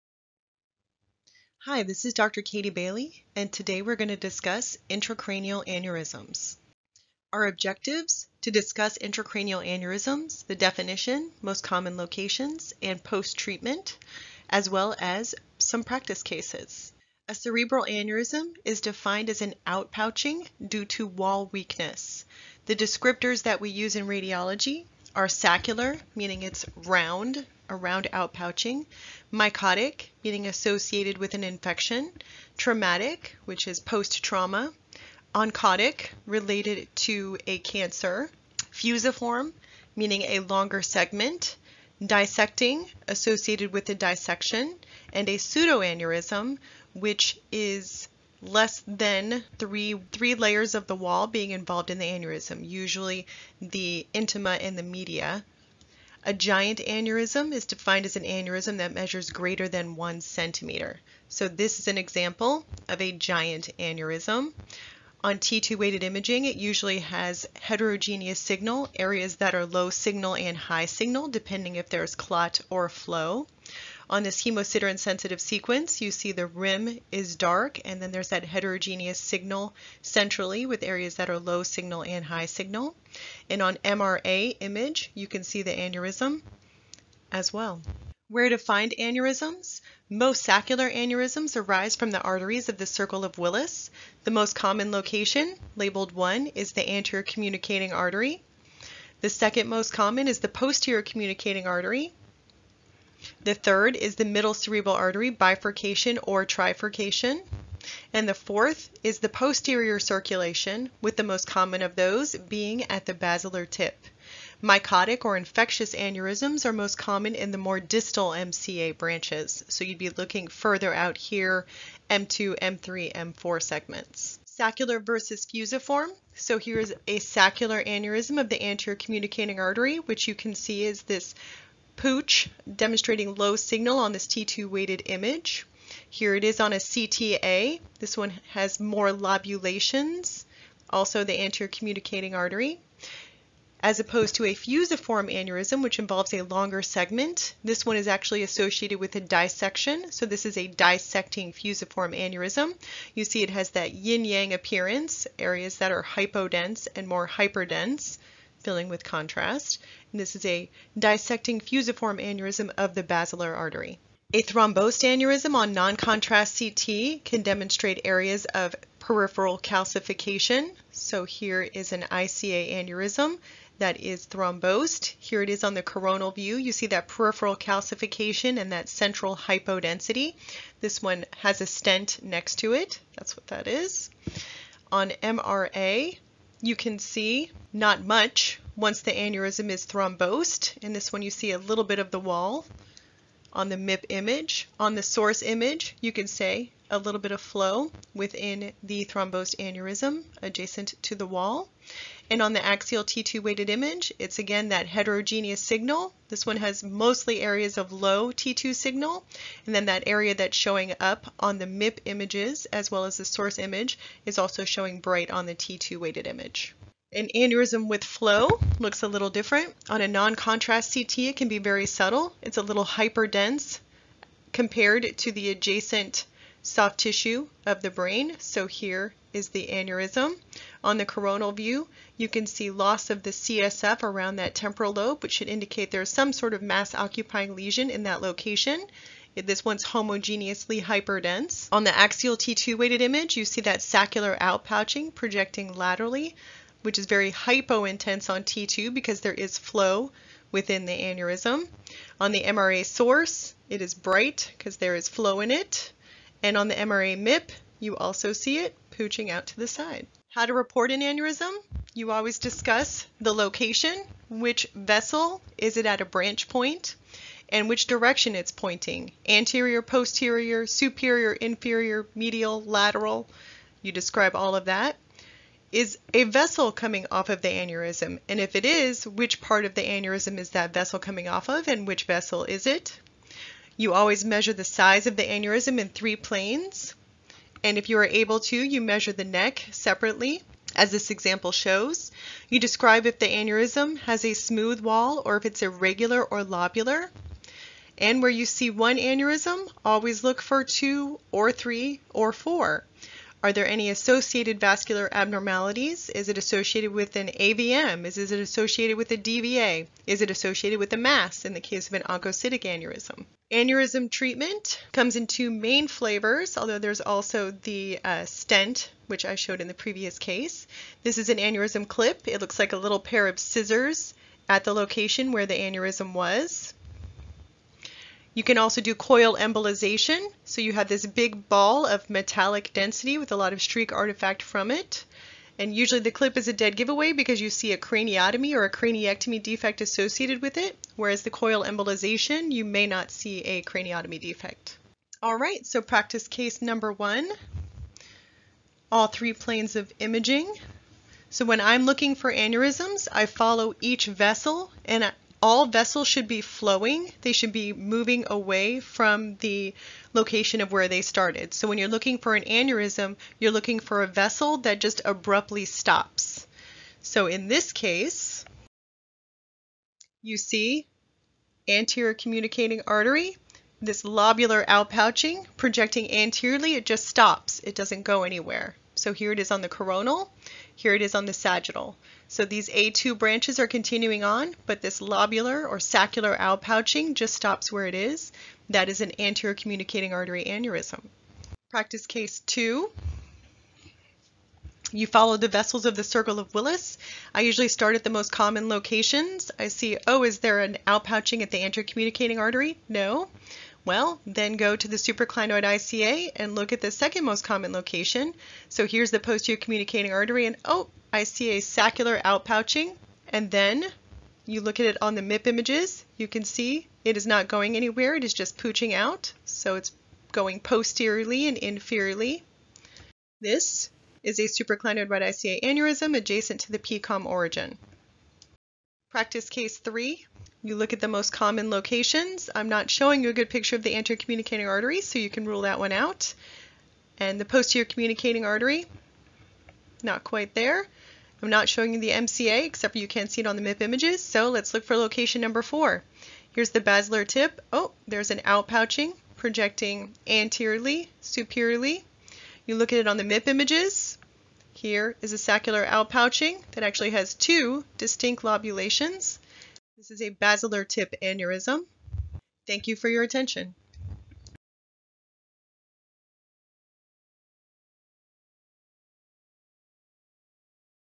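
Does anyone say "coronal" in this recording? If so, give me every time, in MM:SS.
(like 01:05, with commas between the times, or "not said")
02:55, 03:51, 06:19.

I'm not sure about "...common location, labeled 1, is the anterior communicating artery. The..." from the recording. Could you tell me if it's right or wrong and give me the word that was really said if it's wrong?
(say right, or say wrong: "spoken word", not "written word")
right.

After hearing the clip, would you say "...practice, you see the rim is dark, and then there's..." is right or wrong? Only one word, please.
wrong.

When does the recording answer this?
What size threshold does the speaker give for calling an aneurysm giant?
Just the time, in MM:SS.
00:59.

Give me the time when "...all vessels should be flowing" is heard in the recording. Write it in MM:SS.
05:55.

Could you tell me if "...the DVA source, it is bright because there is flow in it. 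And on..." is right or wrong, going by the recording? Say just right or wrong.
wrong.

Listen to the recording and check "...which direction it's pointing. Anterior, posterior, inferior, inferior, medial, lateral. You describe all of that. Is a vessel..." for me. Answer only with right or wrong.
wrong.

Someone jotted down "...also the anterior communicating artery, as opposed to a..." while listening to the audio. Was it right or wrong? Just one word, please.
right.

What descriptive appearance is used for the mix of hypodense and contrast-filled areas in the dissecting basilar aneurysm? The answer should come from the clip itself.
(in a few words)
yin-yang.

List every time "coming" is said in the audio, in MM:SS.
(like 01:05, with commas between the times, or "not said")
04:36, 04:40.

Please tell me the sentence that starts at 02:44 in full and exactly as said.
A thrombosed aneurysm on non-contrast CT can demonstrate areas of peripheral calcification.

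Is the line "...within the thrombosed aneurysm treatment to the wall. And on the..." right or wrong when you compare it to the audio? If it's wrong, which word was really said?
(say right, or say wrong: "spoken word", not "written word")
wrong: "adjacent", not "treatment".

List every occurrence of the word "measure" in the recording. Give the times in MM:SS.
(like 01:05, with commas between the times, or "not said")
00:58, 04:44, 04:48.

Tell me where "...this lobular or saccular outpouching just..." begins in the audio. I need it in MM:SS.
06:24.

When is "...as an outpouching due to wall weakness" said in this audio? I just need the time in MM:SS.
00:19.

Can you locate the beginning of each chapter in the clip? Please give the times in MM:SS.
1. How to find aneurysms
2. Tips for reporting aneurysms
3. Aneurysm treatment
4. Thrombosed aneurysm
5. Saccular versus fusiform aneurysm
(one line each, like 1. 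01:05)
1. 01:27
2. 04:18
3. 05:10
4. 02:42
5. 02:03.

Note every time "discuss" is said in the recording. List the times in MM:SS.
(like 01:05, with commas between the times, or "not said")
00:04, 00:08, 04:22.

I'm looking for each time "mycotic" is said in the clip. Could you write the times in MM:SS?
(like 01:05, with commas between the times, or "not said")
00:29, 01:54.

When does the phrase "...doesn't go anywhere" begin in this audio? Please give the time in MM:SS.
06:17.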